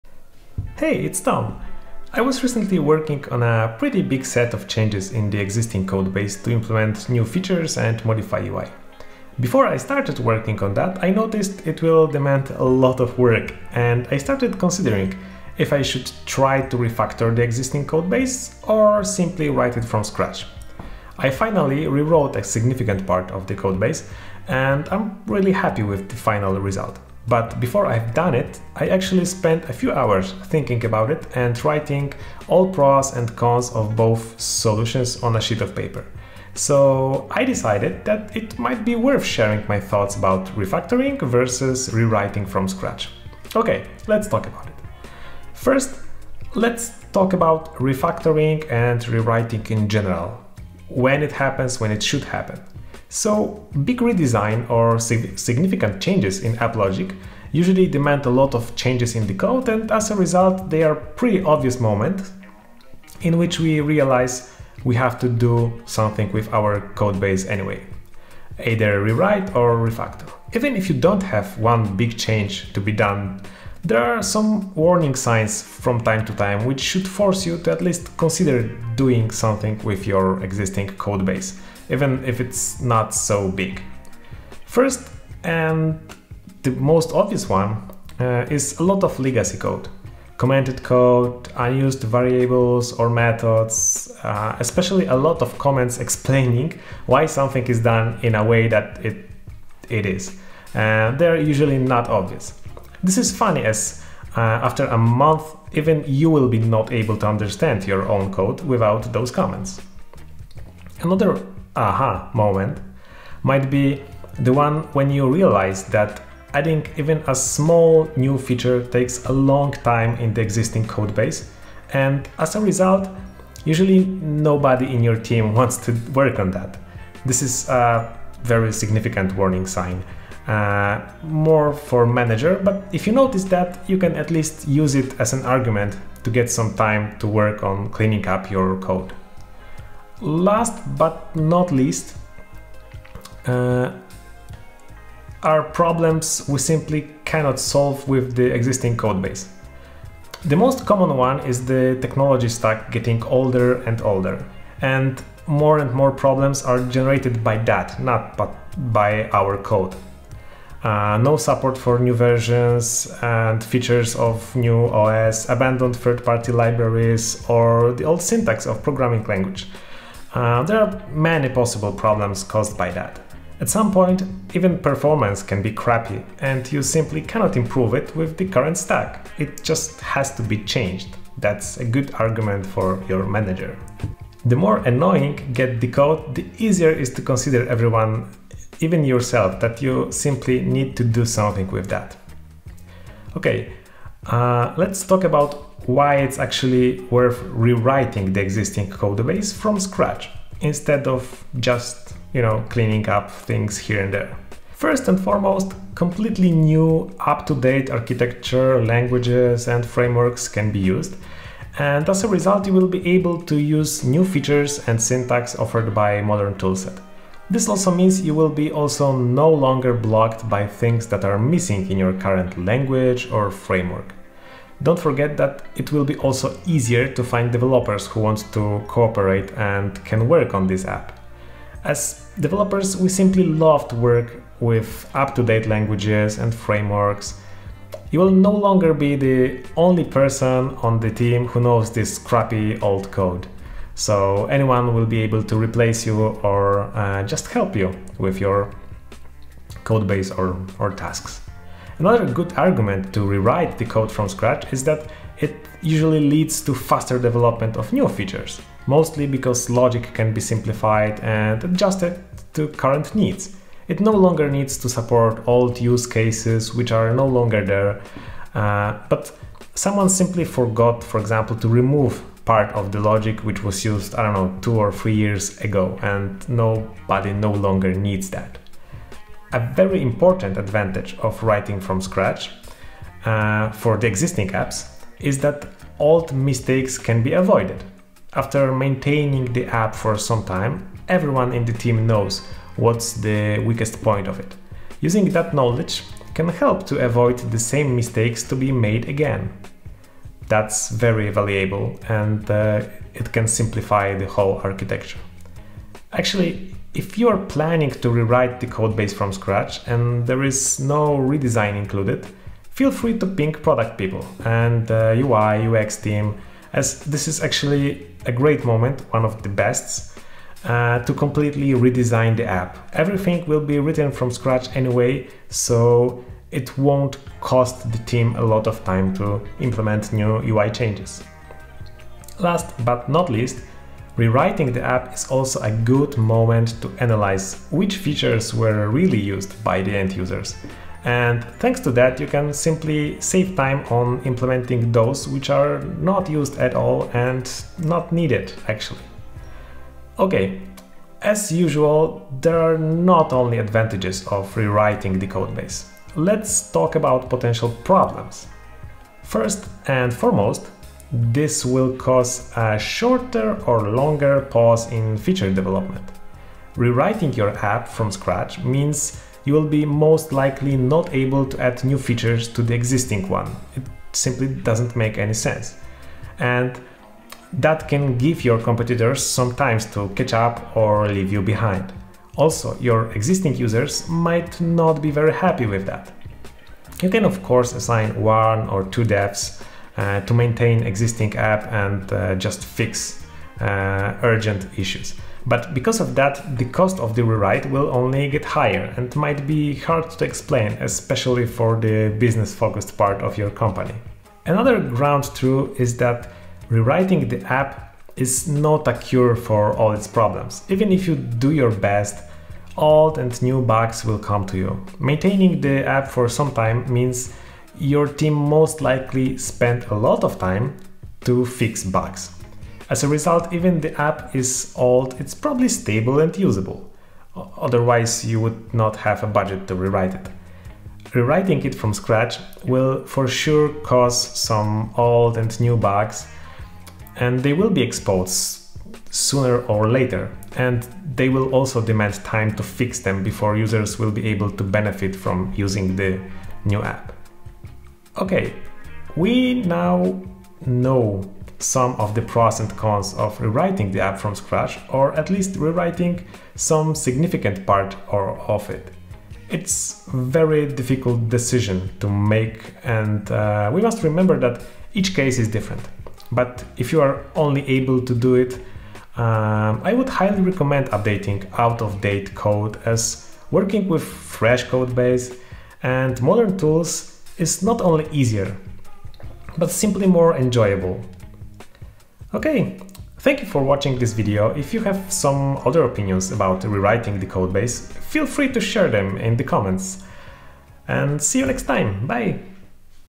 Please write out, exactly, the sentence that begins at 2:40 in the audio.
Uh, no support for new versions and features of new OS, abandoned third-party libraries, or the old syntax of programming language.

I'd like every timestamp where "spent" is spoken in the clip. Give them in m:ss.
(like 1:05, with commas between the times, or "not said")
0:29, 6:59.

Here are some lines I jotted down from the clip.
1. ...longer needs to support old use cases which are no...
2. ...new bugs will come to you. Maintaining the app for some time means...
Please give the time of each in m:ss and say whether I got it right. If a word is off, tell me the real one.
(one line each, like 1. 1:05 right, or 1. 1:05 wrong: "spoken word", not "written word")
1. 4:24 right
2. 6:53 right.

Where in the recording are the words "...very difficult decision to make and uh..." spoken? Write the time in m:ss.
7:40.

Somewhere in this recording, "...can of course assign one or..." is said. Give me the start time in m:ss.
6:27.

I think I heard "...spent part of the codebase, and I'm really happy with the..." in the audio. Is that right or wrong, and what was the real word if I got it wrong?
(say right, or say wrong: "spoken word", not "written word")
wrong: "significant", not "spent".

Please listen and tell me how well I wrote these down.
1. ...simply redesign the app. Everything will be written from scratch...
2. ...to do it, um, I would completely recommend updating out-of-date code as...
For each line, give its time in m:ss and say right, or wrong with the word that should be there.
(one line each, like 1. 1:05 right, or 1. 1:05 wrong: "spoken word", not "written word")
1. 5:21 wrong: "completely", not "simply"
2. 7:48 wrong: "highly", not "completely".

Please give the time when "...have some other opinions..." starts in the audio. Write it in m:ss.
8:04.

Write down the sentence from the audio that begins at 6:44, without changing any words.
Another ground truth is that rewriting the app is not a cure for all its problems.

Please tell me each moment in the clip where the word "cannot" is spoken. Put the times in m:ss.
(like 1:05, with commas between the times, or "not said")
2:27, 2:57.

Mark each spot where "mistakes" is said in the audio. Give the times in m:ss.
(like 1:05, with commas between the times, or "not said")
4:46, 4:57.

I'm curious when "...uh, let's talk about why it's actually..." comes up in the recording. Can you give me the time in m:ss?
3:14.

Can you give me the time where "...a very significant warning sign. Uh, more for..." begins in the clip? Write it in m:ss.
2:07.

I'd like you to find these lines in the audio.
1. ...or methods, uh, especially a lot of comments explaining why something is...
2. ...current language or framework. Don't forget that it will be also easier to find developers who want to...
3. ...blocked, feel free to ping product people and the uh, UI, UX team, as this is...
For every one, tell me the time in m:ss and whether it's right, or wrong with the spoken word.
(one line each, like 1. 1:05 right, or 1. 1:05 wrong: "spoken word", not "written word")
1. 1:32 right
2. 3:42 right
3. 5:11 wrong: "included", not "blocked".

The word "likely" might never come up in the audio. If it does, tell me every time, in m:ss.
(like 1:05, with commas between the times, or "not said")
6:10, 6:58.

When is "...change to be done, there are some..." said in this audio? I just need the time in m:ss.
1:12.